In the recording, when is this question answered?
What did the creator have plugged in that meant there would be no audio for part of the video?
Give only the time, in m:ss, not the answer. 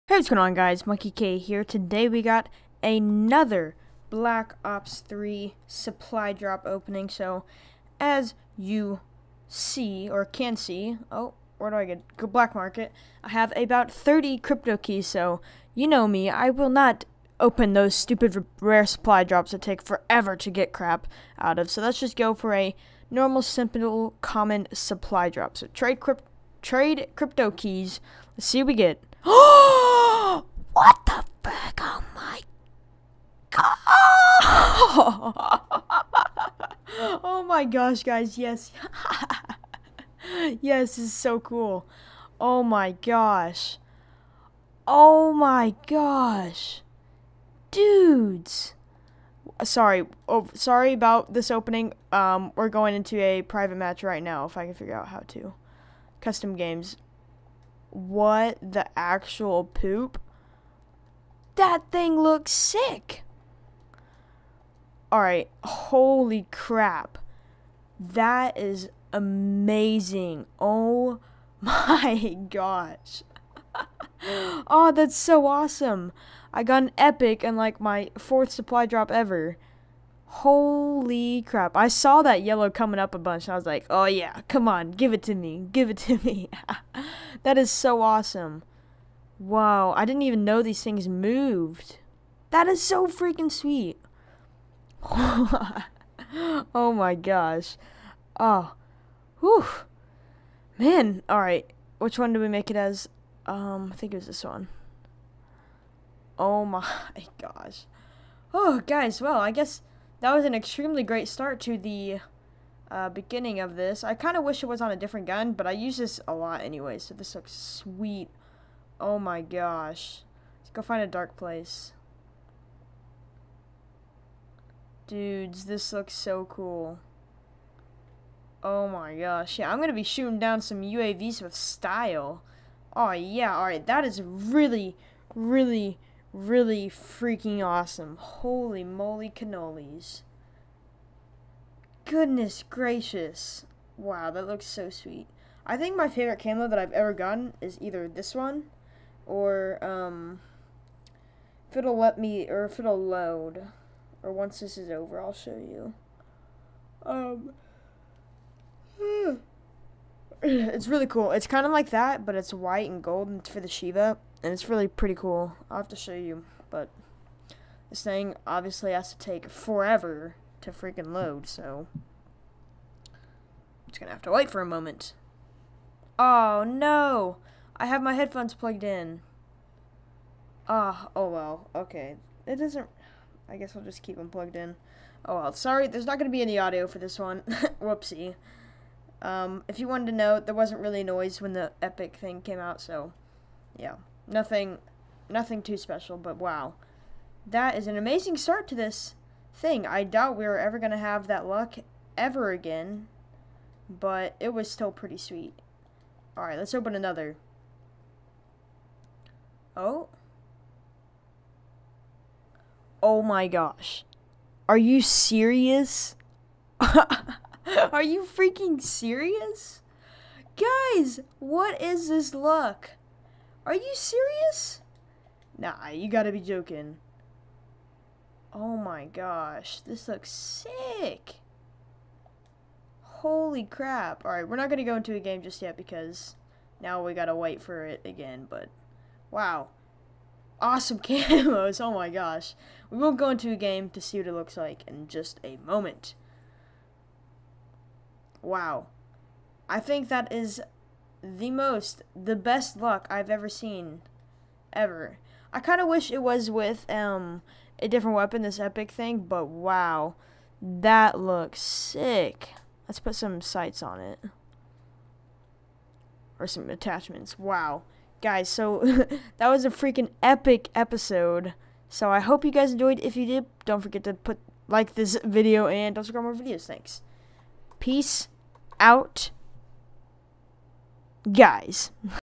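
2:58.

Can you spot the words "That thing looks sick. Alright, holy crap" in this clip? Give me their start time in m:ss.
1:01.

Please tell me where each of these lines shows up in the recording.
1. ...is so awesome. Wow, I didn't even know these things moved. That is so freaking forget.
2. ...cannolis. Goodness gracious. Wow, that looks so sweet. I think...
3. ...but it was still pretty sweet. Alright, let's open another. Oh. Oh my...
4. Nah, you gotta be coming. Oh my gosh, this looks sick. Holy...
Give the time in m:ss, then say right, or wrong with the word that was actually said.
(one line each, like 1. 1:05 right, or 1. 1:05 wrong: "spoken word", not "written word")
1. 1:27 wrong: "sweet", not "forget"
2. 2:19 right
3. 3:23 right
4. 3:45 wrong: "joking", not "coming".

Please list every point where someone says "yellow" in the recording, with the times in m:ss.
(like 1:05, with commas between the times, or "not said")
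1:22.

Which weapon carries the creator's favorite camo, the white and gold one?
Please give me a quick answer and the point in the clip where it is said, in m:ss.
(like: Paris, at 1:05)
Shieva, at 2:43.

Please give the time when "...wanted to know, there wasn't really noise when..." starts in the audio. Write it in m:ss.
3:09.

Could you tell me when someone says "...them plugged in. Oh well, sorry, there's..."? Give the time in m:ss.
3:04.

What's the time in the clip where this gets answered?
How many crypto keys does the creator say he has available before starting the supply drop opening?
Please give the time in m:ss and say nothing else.
0:13.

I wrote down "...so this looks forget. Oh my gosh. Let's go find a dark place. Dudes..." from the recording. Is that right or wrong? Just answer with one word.
wrong.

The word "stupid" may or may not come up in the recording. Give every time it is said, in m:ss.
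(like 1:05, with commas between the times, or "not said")
0:17.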